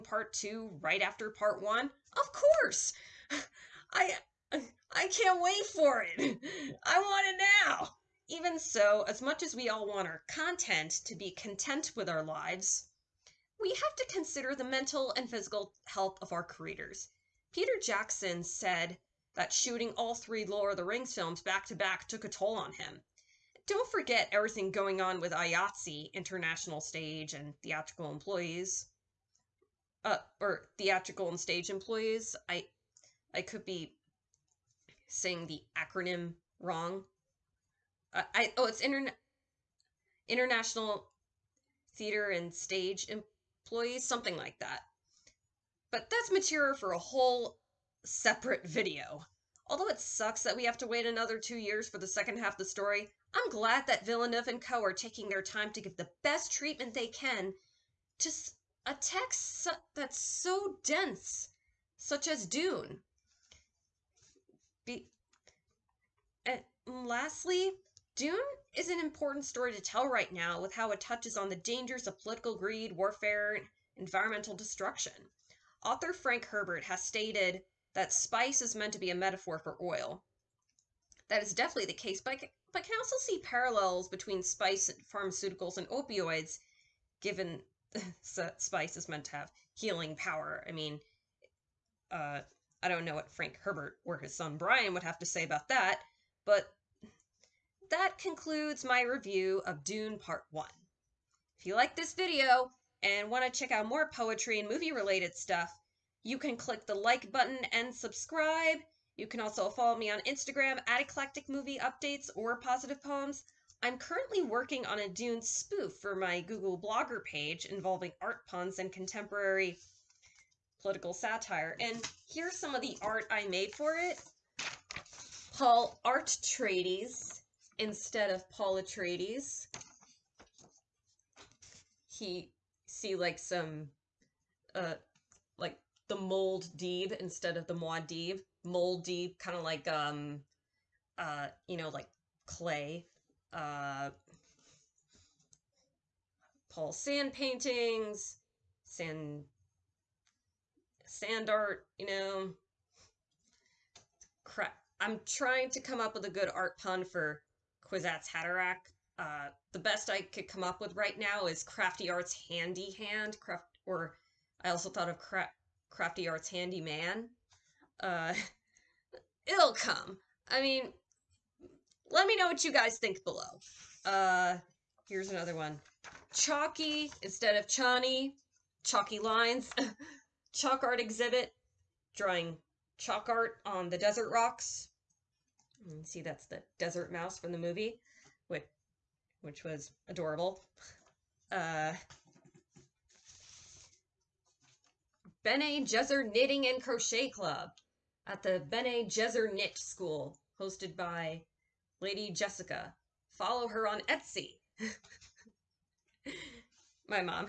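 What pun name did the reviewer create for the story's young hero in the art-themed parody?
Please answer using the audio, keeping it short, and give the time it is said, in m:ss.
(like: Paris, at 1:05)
Paul Artreides, at 2:05.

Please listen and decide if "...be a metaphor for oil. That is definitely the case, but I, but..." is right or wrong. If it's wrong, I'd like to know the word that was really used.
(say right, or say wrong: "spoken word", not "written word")
right.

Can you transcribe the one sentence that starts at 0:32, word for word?
I I could be saying the acronym wrong.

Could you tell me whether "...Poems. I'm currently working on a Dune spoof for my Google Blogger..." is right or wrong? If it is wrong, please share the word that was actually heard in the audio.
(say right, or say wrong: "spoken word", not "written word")
right.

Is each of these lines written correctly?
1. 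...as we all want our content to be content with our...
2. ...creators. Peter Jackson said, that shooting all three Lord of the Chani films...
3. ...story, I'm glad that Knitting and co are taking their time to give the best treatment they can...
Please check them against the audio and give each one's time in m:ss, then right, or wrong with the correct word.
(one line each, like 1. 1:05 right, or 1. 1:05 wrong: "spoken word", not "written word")
1. 0:09 right
2. 0:16 wrong: "Rings", not "Chani"
3. 0:52 wrong: "Villeneuve", not "Knitting".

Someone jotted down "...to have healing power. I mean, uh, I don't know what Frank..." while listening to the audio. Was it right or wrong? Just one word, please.
right.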